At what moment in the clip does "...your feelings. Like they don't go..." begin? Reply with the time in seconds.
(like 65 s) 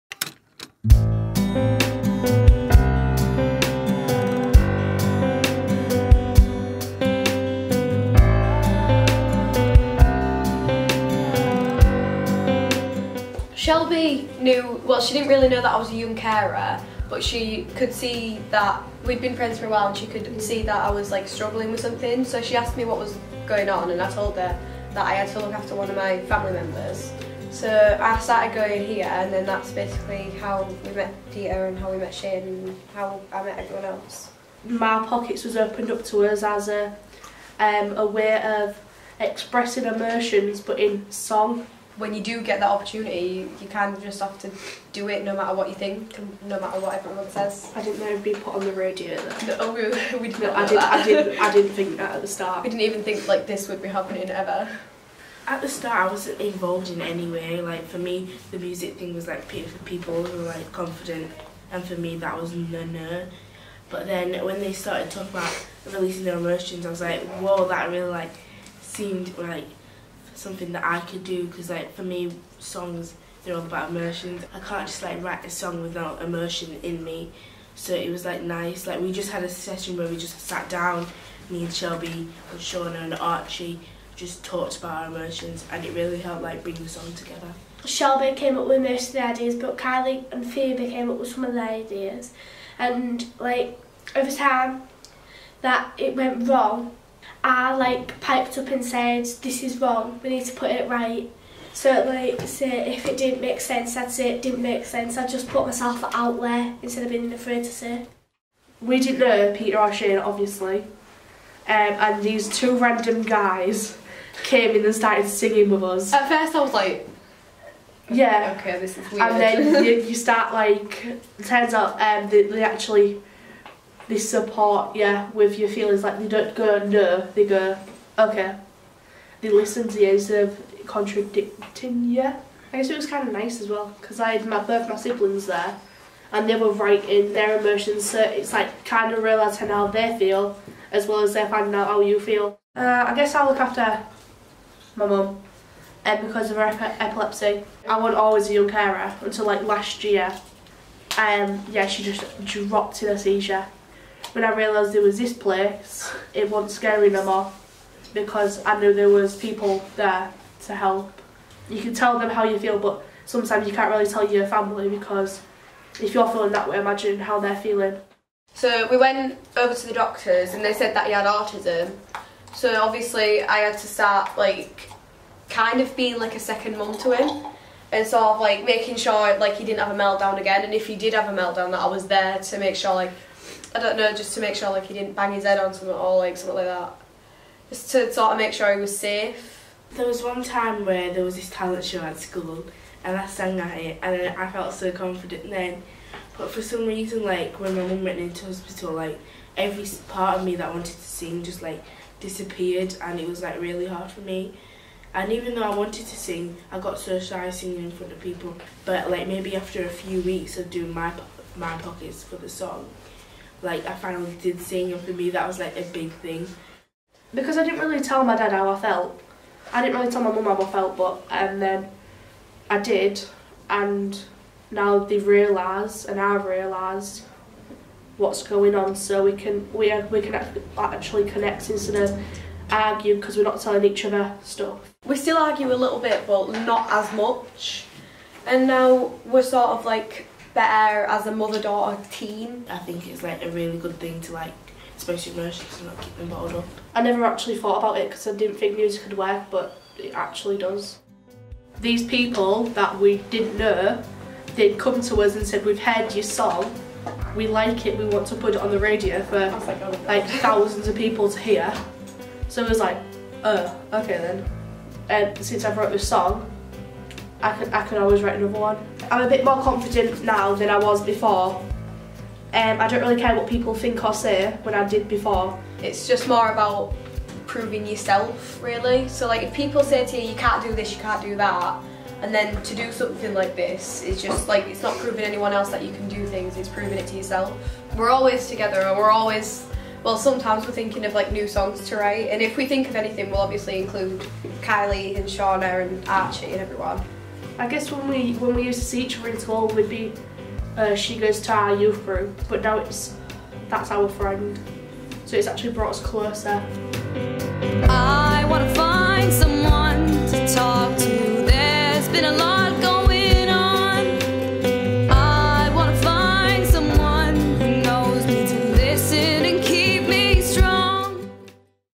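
125 s.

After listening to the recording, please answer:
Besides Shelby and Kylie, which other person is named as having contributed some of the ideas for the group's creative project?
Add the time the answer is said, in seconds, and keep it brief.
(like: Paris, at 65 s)
Phoebe, at 90 s.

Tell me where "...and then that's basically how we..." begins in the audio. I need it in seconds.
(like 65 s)
29 s.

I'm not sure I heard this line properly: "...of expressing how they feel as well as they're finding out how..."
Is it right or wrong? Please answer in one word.
wrong.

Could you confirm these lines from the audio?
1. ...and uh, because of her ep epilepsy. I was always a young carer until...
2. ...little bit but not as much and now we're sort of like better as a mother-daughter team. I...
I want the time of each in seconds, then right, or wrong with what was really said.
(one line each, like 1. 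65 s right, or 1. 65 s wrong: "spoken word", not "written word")
1. 146 s right
2. 235 s right.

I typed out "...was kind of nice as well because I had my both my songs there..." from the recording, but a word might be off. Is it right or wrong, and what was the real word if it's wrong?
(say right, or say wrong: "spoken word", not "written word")
wrong: "siblings", not "songs".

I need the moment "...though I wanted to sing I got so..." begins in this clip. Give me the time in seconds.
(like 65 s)
205 s.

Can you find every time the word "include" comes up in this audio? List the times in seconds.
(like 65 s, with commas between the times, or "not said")
293 s.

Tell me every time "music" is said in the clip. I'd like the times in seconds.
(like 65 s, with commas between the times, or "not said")
58 s, 248 s.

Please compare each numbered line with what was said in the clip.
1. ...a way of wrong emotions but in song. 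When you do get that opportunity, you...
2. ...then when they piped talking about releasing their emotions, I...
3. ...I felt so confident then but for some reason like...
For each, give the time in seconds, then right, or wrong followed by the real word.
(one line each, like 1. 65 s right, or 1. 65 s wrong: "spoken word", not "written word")
1. 37 s wrong: "expressing", not "wrong"
2. 64 s wrong: "started", not "piped"
3. 194 s right.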